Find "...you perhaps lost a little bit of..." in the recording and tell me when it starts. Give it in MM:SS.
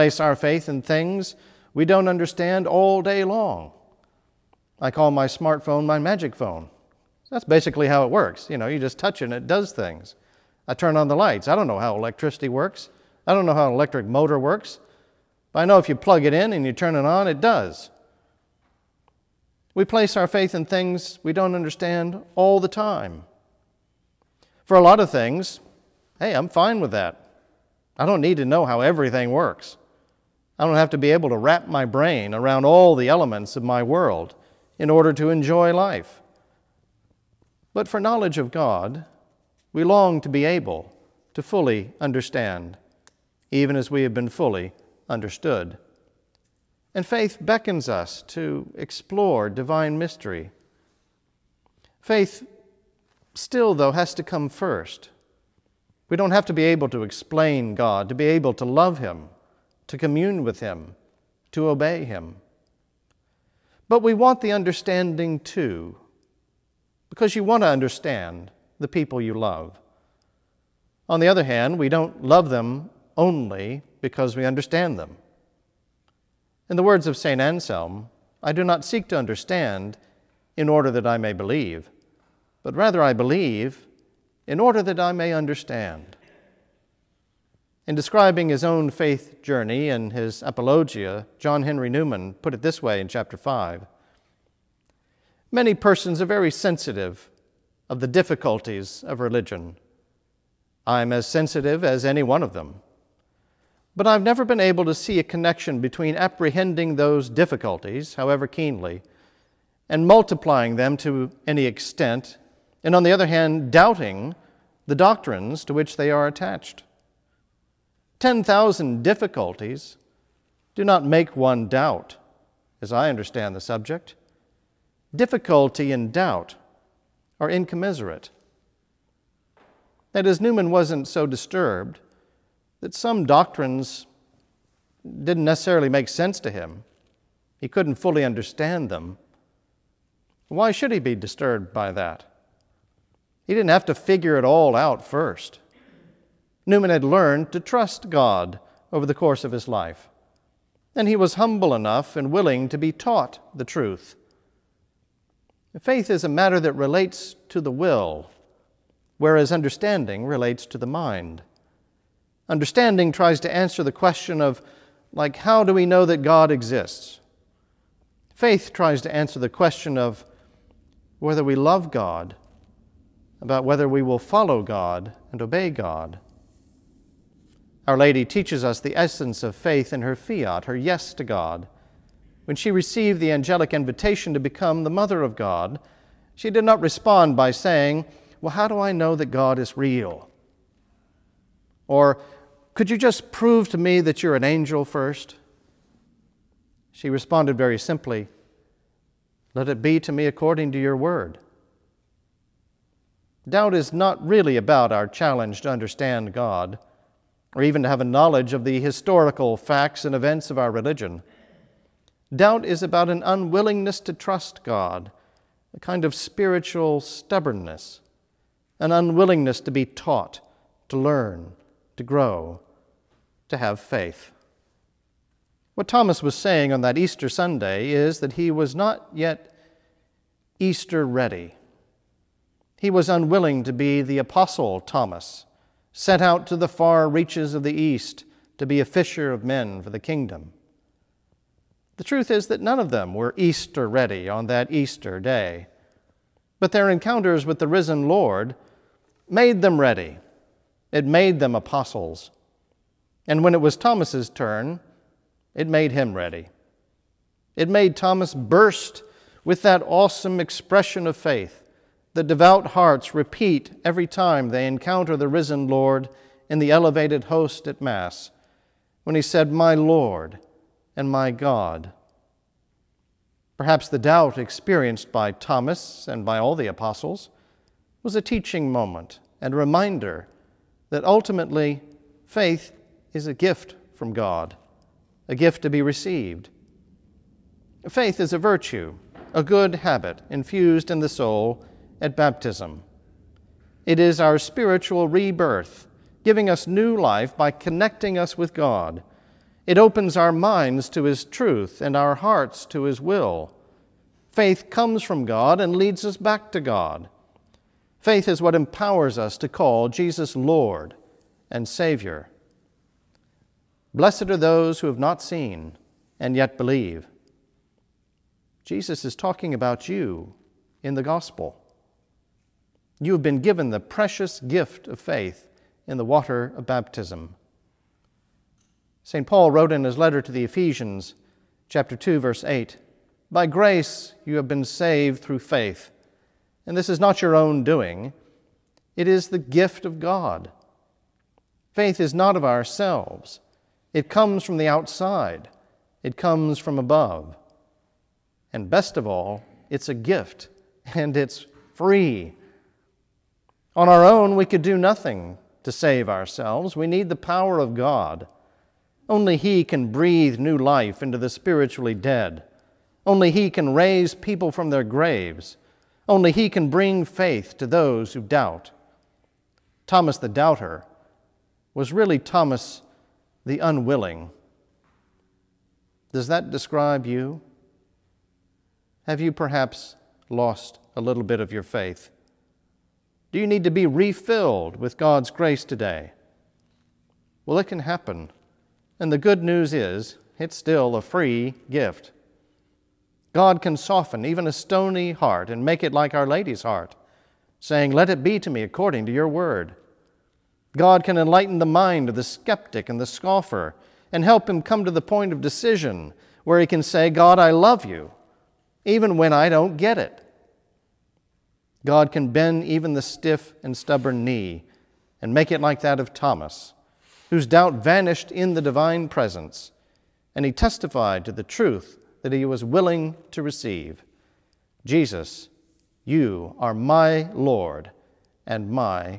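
06:19.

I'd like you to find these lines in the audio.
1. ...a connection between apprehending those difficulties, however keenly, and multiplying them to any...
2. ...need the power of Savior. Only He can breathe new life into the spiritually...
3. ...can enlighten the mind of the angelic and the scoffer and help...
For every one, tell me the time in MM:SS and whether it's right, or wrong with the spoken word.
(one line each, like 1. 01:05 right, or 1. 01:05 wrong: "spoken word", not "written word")
1. 01:45 right
2. 05:56 wrong: "God", not "Savior"
3. 06:41 wrong: "skeptic", not "angelic".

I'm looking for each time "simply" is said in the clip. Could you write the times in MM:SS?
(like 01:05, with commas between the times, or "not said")
03:17.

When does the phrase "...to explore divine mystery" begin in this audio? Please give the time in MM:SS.
00:48.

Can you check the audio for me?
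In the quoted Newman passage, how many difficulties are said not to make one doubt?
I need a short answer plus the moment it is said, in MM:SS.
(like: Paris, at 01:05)
10,000, at 01:58.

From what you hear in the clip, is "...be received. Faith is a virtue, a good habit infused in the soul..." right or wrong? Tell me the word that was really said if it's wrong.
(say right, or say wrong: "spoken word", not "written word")
right.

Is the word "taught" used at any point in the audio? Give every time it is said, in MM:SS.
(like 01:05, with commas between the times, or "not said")
02:32, 03:39.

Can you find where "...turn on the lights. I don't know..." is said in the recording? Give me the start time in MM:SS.
00:10.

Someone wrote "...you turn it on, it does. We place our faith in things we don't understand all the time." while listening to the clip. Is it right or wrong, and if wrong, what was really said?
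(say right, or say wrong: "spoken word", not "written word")
right.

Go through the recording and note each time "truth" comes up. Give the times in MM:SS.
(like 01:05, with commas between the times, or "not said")
02:33, 04:02, 05:01, 07:01.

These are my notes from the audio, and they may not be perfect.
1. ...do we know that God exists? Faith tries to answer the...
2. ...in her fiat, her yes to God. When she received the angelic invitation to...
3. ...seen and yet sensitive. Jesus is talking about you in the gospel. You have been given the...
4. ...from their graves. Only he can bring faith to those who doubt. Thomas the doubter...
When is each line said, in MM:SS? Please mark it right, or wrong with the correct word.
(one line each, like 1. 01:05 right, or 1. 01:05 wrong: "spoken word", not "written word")
1. 02:45 right
2. 02:59 right
3. 05:15 wrong: "believe", not "sensitive"
4. 06:04 right.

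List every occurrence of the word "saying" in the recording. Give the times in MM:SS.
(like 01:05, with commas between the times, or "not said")
03:07, 03:46, 06:37.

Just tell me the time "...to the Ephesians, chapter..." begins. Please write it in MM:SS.
05:30.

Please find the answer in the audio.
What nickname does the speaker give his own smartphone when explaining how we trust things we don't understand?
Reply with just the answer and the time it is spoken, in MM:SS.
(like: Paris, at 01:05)
my magic phone, at 00:05.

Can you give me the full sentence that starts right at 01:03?
But we want the understanding too, because you want to understand the people you love.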